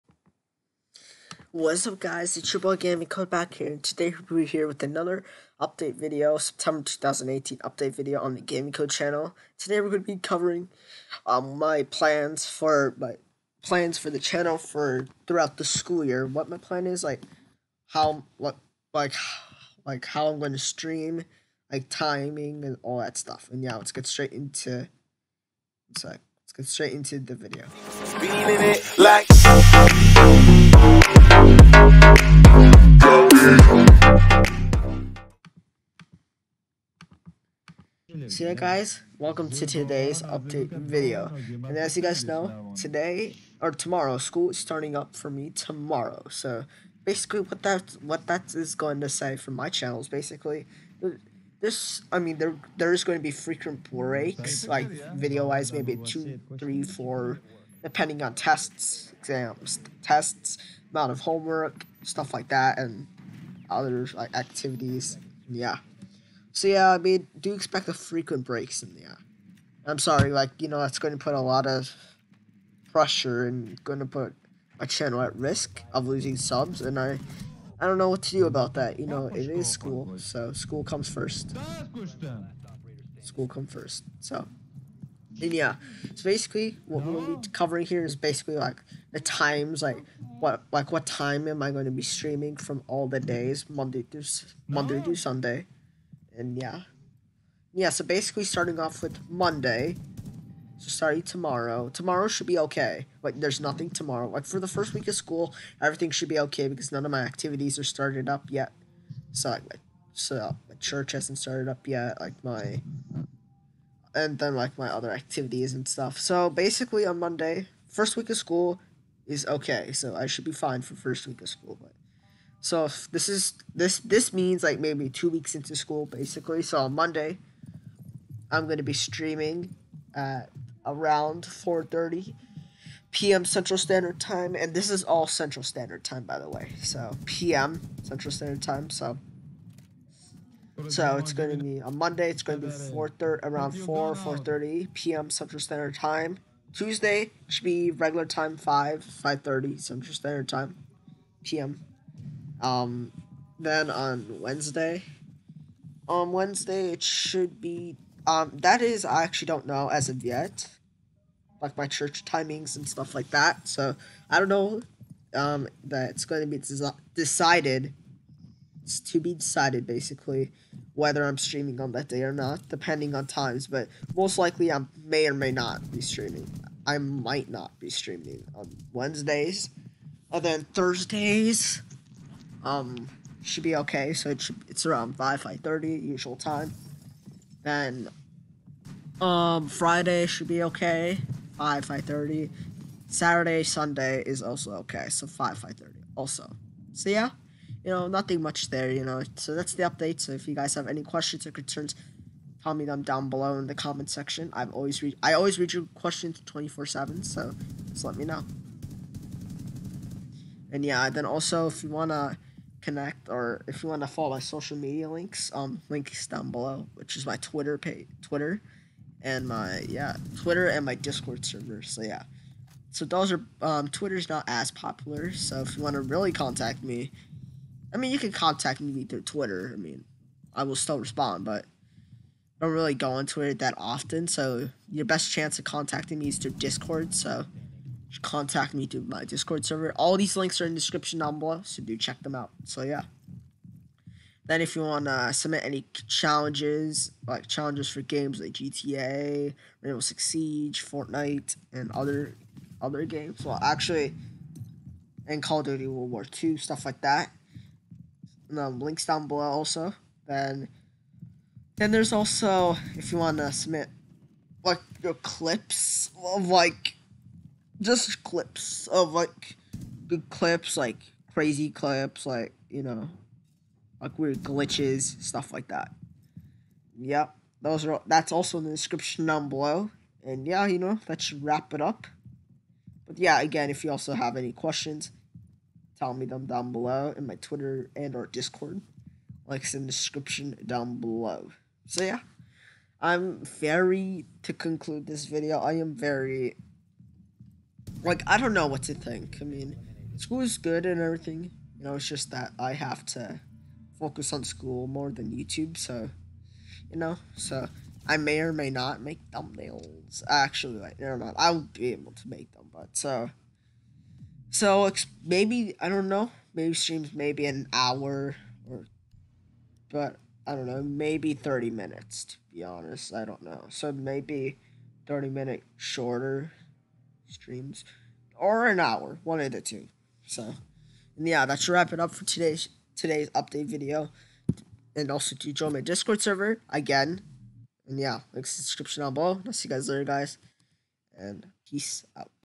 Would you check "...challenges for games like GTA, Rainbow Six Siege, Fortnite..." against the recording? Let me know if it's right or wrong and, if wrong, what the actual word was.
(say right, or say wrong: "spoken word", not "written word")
right.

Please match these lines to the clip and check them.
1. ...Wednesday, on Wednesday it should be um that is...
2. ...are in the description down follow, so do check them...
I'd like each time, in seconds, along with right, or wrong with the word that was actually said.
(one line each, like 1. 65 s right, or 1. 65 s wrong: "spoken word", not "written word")
1. 154 s right
2. 240 s wrong: "below", not "follow".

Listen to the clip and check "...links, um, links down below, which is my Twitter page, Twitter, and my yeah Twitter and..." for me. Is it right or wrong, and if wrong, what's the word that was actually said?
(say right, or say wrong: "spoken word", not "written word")
right.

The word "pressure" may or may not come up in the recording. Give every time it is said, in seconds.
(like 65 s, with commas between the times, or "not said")
72 s.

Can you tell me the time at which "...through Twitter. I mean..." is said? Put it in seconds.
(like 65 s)
229 s.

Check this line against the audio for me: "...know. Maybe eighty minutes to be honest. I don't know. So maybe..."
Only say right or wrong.
wrong.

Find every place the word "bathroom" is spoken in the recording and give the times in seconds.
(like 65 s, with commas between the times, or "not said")
not said.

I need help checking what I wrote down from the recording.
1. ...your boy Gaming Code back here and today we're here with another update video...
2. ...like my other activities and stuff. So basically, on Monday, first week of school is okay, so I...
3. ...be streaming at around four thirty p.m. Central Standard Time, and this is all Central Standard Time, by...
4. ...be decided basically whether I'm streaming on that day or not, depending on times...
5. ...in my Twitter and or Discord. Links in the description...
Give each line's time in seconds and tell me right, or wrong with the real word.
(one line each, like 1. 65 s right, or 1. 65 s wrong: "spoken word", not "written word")
1. 2 s right
2. 114 s right
3. 128 s right
4. 169 s right
5. 287 s right.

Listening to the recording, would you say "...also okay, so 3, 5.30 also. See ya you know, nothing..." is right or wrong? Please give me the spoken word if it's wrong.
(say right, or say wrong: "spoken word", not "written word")
wrong: "5", not "3".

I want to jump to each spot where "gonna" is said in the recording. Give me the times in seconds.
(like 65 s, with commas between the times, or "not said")
128 s.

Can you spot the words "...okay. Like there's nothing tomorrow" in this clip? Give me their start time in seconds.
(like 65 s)
102 s.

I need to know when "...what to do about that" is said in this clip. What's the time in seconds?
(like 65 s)
78 s.